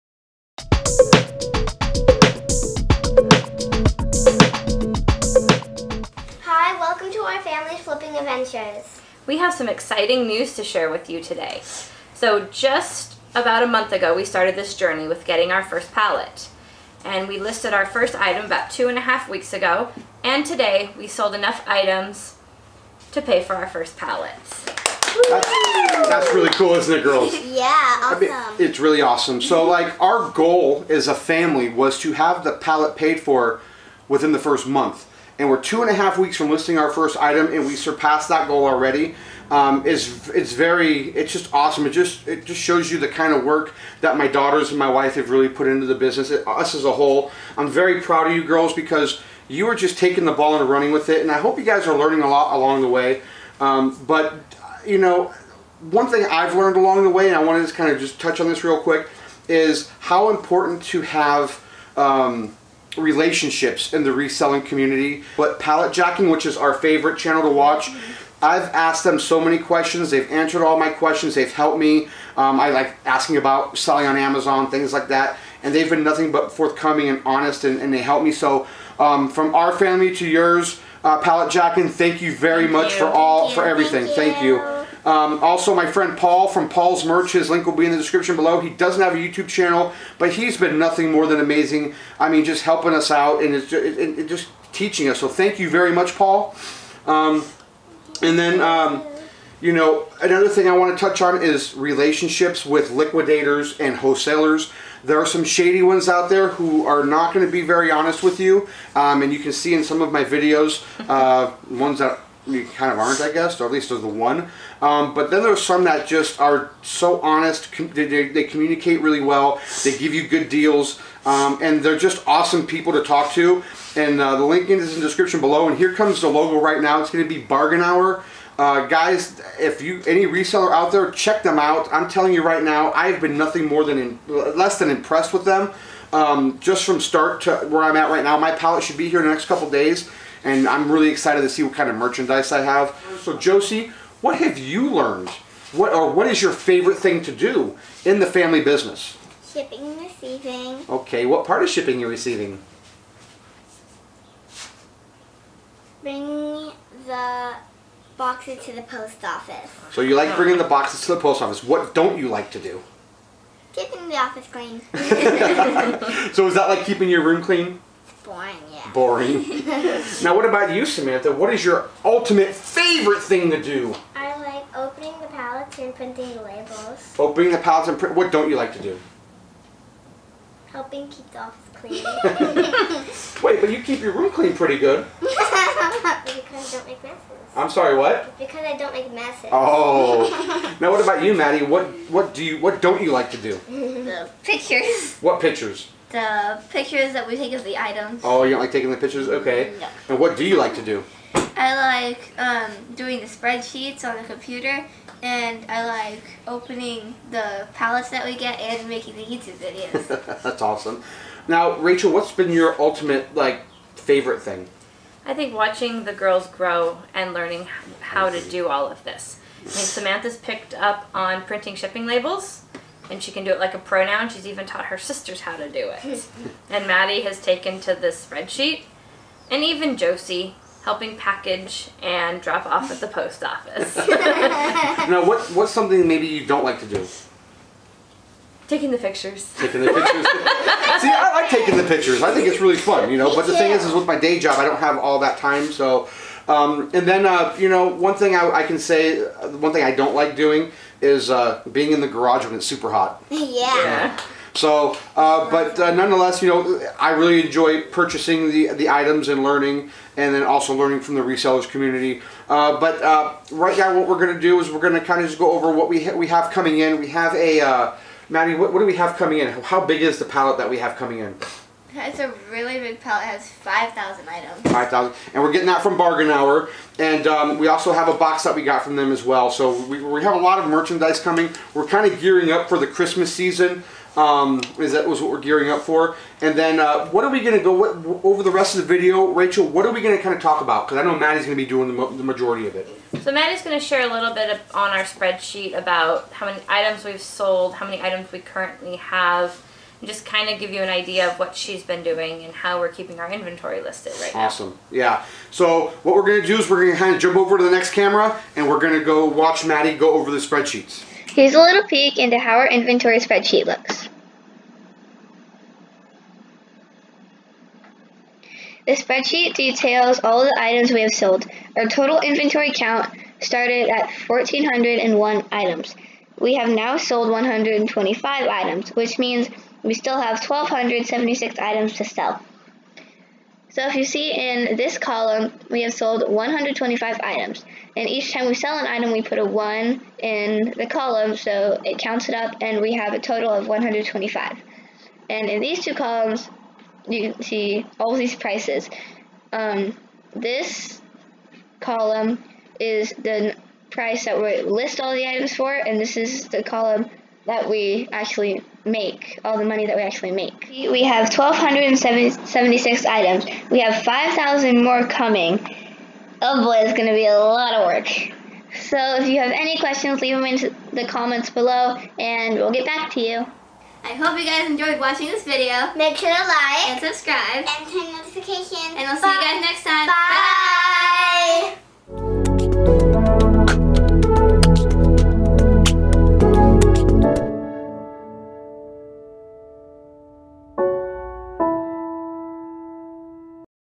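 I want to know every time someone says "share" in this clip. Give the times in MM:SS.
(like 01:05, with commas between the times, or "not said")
00:10, 04:53.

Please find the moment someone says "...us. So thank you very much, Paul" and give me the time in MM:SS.
01:35.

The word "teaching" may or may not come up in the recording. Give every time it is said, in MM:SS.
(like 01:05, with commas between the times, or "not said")
01:34.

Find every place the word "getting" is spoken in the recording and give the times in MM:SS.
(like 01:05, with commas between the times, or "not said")
00:15, 04:35.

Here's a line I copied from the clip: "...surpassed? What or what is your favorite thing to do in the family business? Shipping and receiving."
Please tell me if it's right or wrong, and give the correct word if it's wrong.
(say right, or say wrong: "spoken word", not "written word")
wrong: "learned", not "surpassed".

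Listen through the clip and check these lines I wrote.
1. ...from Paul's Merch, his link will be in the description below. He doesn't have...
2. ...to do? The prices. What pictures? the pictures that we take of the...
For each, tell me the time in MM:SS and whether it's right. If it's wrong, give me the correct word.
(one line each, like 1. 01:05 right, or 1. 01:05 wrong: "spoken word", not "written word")
1. 01:26 right
2. 03:13 wrong: "pictures", not "prices".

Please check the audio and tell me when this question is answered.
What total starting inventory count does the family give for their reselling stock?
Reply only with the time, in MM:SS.
05:24.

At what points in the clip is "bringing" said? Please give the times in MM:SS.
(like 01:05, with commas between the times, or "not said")
02:36, 02:40.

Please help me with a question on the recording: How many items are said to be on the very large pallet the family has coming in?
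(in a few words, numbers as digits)
5,000.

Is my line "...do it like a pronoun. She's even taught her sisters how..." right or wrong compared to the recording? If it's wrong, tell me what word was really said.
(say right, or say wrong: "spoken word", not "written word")
right.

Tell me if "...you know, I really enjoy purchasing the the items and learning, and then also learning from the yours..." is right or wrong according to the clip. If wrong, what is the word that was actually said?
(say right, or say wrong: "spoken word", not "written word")
wrong: "resellers", not "yours".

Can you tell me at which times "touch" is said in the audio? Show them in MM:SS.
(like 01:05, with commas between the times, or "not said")
00:58, 01:41.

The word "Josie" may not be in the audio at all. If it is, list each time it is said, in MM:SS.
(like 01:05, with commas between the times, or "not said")
02:23, 03:49.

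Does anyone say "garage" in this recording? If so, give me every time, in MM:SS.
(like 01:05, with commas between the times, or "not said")
04:12.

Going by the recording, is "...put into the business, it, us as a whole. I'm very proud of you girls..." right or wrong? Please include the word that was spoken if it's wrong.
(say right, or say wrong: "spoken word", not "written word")
right.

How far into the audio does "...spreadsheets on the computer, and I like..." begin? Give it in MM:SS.
03:23.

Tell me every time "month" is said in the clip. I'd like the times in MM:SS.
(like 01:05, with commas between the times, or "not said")
00:13, 00:34.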